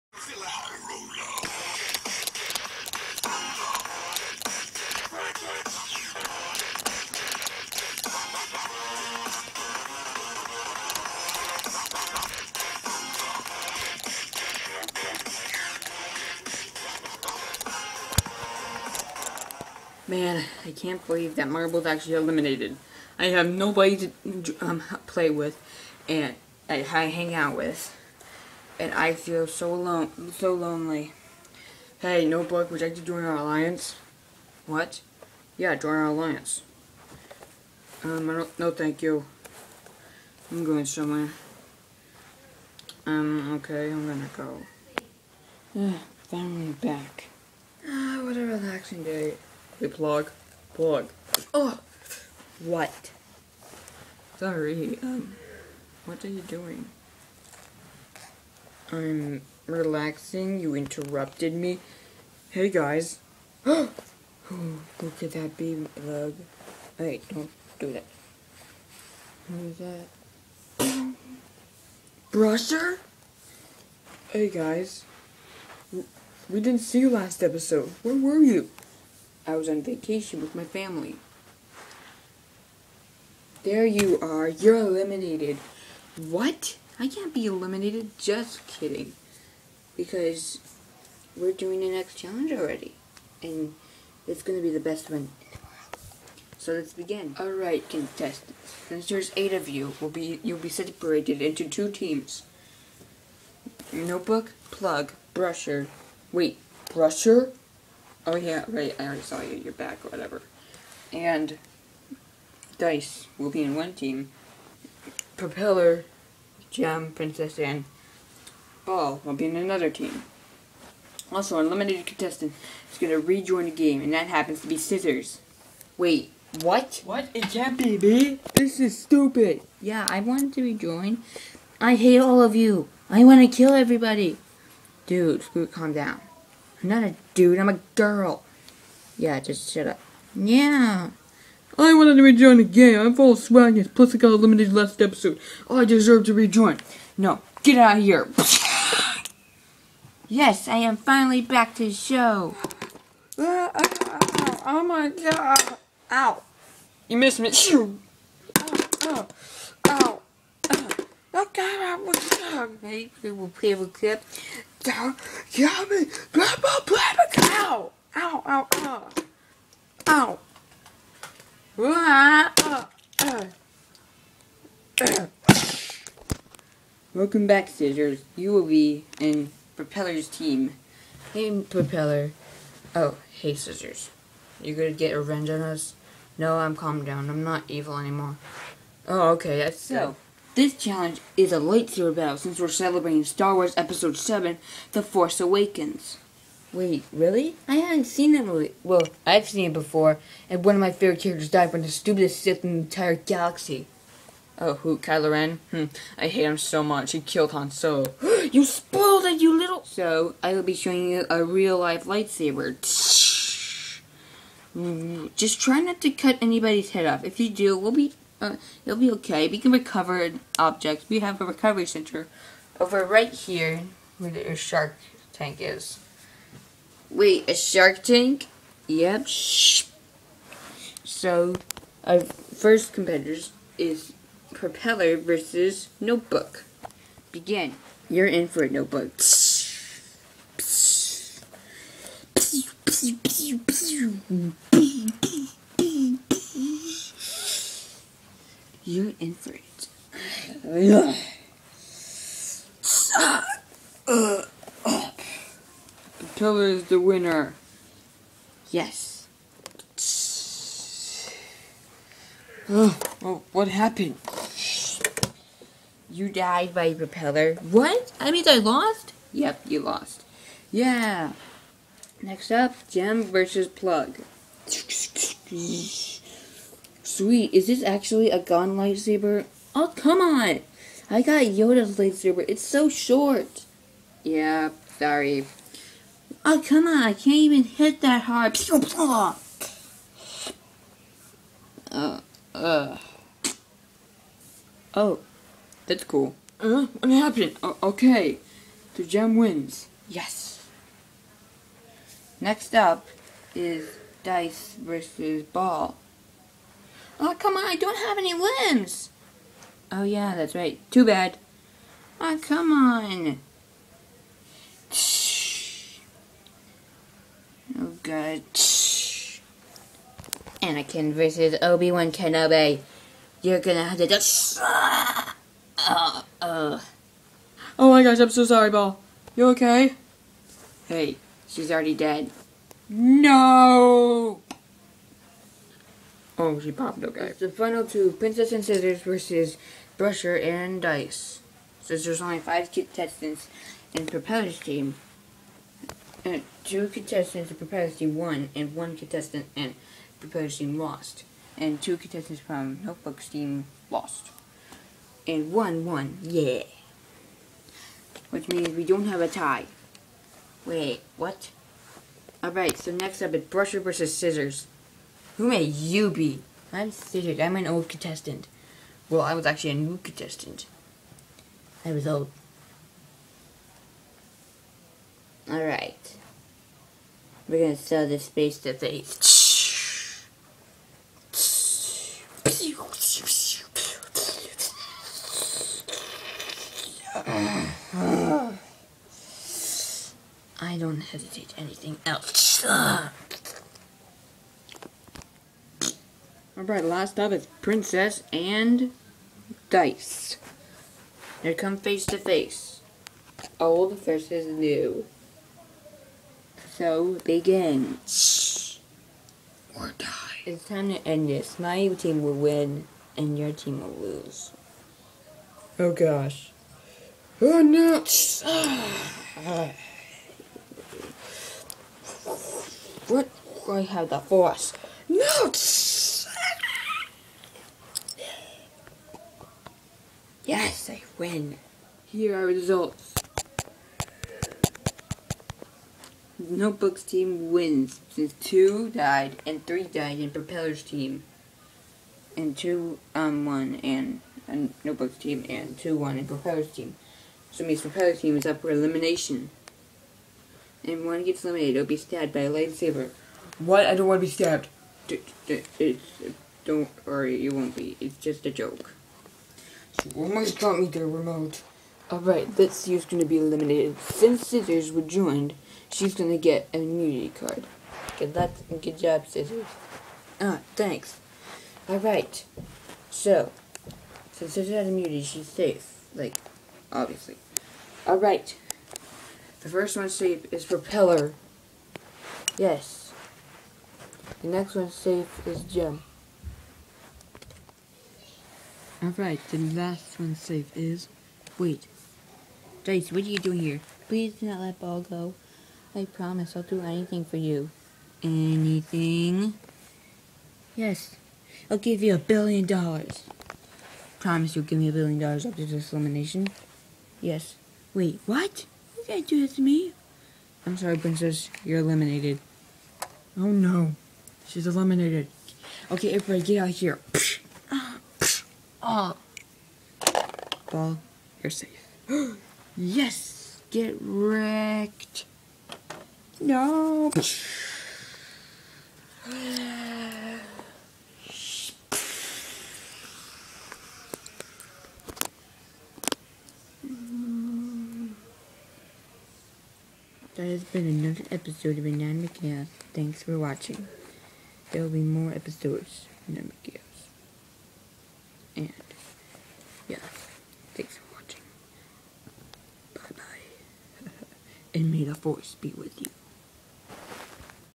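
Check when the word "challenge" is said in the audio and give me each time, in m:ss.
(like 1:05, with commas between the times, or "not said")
1:32, 3:10.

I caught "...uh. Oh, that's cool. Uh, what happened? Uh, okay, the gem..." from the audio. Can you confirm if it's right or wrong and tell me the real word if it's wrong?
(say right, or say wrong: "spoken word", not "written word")
right.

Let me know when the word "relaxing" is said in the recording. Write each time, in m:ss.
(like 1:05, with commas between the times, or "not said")
0:48, 0:59.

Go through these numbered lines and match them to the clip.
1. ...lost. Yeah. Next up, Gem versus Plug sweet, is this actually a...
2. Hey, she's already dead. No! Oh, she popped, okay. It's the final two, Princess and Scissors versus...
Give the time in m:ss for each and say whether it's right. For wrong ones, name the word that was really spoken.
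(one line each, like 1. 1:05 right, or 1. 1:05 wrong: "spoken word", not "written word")
1. 4:29 right
2. 5:30 right.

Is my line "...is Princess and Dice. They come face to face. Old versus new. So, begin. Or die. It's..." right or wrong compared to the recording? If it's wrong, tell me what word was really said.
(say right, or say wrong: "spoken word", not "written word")
right.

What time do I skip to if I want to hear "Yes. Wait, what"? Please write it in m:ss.
8:27.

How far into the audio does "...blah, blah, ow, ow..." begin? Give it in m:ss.
2:46.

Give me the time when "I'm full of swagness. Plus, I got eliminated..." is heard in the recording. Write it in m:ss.
2:22.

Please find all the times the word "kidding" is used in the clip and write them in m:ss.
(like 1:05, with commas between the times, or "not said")
1:28.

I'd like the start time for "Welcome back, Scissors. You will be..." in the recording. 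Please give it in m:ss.
2:57.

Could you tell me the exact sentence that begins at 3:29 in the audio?
So, I will be showing you a real-life lightsaber.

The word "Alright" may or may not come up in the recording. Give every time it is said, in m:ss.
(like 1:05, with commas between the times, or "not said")
1:37, 6:02, 6:15, 6:36, 7:42, 7:51, 7:58, 8:09.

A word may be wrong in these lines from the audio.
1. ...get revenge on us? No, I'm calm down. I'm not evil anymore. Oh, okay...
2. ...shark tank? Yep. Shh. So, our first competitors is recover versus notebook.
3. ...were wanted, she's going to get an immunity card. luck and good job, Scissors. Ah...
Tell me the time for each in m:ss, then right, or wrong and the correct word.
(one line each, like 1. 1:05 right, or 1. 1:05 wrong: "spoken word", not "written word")
1. 3:04 right
2. 3:47 wrong: "propeller", not "recover"
3. 7:44 wrong: "joined", not "wanted".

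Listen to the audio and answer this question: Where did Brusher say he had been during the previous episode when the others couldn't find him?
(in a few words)
On vacation.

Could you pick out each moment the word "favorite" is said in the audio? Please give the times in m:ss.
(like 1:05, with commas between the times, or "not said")
3:20.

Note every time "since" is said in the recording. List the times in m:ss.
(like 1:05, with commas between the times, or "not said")
1:38, 3:12, 5:41, 7:18, 7:43, 7:54.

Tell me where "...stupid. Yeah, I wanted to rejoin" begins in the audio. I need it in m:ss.
2:08.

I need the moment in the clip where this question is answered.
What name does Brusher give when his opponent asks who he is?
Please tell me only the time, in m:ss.
6:06.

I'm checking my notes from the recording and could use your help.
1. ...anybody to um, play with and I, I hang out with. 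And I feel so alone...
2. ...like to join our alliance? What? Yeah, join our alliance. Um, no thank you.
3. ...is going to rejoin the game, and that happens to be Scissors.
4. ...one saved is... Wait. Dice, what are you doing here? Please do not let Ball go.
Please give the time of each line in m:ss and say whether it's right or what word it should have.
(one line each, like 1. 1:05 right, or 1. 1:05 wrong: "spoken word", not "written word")
1. 0:23 wrong: "nobody", not "anybody"
2. 0:32 right
3. 2:02 right
4. 8:10 right.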